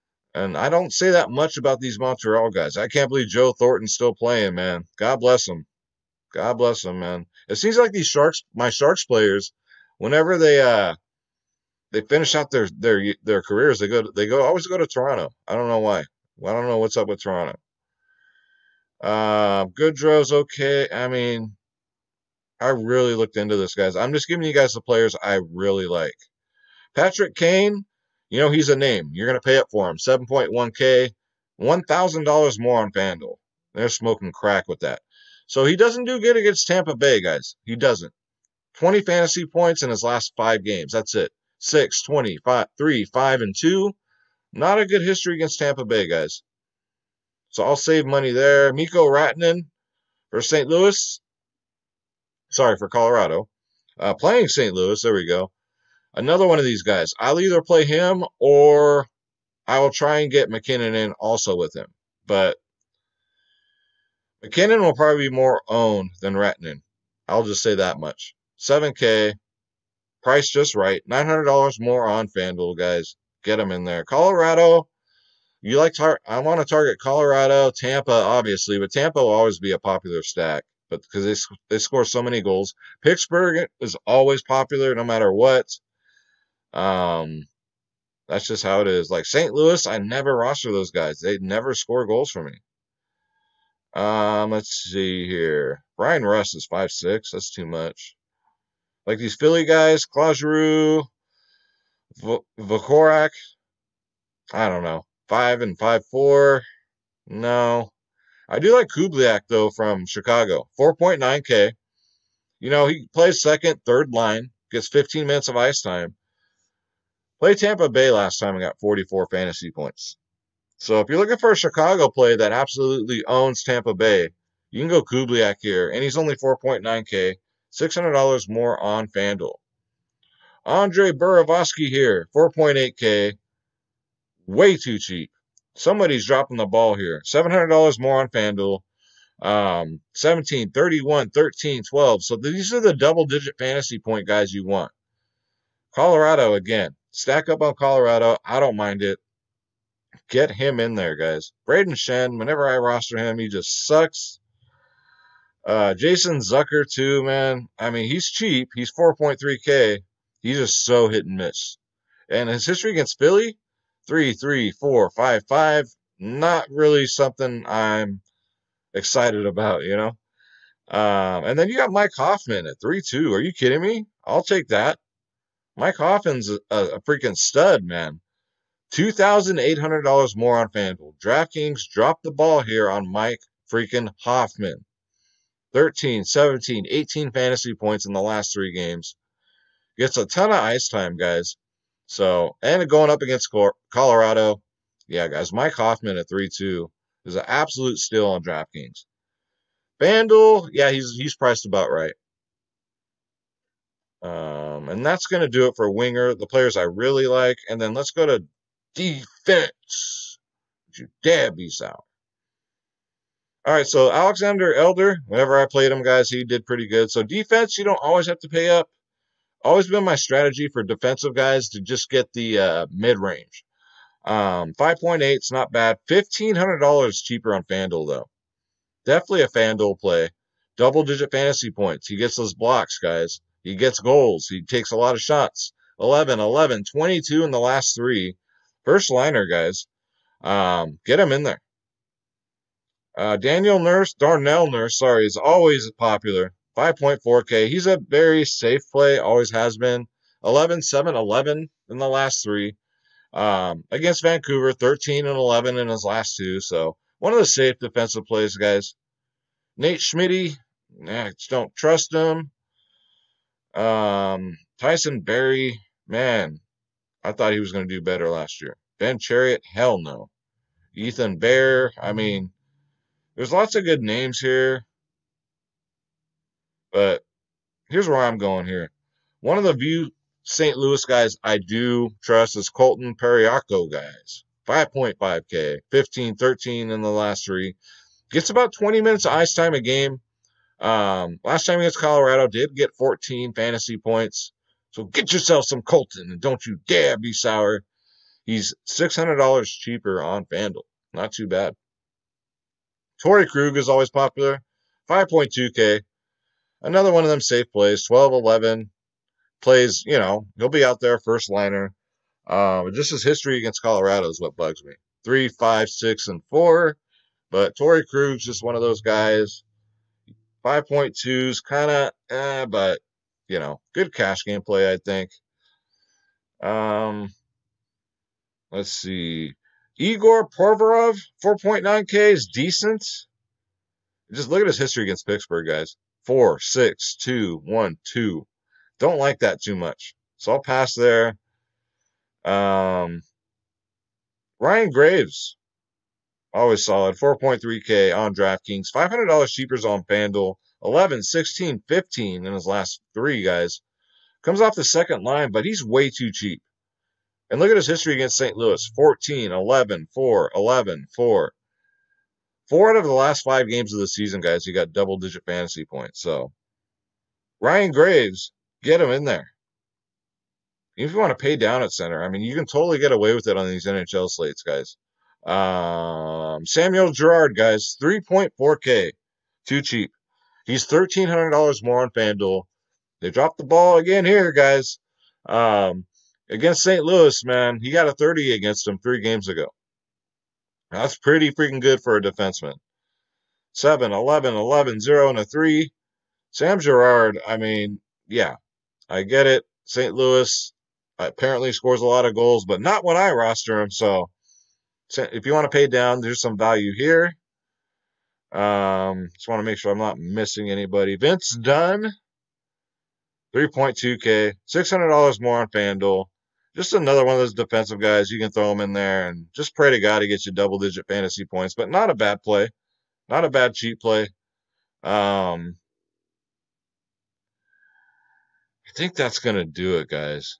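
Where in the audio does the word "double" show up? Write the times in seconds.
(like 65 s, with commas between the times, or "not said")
142 s, 230 s, 364 s, 420 s.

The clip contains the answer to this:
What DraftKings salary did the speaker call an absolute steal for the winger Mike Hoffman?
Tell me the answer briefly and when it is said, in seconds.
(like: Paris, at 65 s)
3.2K, at 172 s.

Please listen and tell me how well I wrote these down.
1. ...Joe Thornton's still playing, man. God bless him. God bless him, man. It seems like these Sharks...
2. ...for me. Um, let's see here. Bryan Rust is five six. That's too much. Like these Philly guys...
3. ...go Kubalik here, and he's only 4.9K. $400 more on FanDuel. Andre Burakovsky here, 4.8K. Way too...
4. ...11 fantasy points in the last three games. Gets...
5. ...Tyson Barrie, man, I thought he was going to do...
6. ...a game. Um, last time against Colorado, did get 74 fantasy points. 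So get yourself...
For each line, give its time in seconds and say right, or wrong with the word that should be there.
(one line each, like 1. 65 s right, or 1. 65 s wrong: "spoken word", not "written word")
1. 3 s right
2. 92 s right
3. 124 s wrong: "600", not "400"
4. 186 s wrong: "18", not "11"
5. 264 s right
6. 289 s wrong: "14", not "74".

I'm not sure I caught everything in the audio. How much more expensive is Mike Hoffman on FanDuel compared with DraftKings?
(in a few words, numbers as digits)
$2,800.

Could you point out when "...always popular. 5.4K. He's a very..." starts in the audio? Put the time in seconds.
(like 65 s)
245 s.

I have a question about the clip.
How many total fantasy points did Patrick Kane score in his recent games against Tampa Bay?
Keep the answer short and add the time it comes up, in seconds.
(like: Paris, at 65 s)
20, at 38 s.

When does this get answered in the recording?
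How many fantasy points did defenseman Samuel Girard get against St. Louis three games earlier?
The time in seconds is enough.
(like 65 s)
388 s.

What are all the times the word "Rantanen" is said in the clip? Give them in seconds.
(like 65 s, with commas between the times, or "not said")
49 s, 66 s.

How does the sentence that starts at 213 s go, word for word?
All right, so Alexander Edler, whenever I played him, guys, he did pretty good.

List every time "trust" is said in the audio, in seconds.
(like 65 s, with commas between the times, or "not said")
261 s, 282 s.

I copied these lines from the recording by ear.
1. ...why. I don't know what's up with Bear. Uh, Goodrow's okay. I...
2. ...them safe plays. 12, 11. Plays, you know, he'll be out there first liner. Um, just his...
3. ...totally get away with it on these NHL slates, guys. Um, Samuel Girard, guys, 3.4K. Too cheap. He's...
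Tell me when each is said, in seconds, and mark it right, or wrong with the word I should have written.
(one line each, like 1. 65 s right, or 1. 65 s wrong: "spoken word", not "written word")
1. 15 s wrong: "Toronto", not "Bear"
2. 307 s right
3. 372 s right.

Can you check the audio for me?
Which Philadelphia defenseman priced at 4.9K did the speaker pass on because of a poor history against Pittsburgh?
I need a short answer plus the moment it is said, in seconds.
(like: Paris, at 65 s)
Igor Provorov, at 329 s.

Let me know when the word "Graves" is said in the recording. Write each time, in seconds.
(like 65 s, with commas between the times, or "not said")
344 s, 367 s.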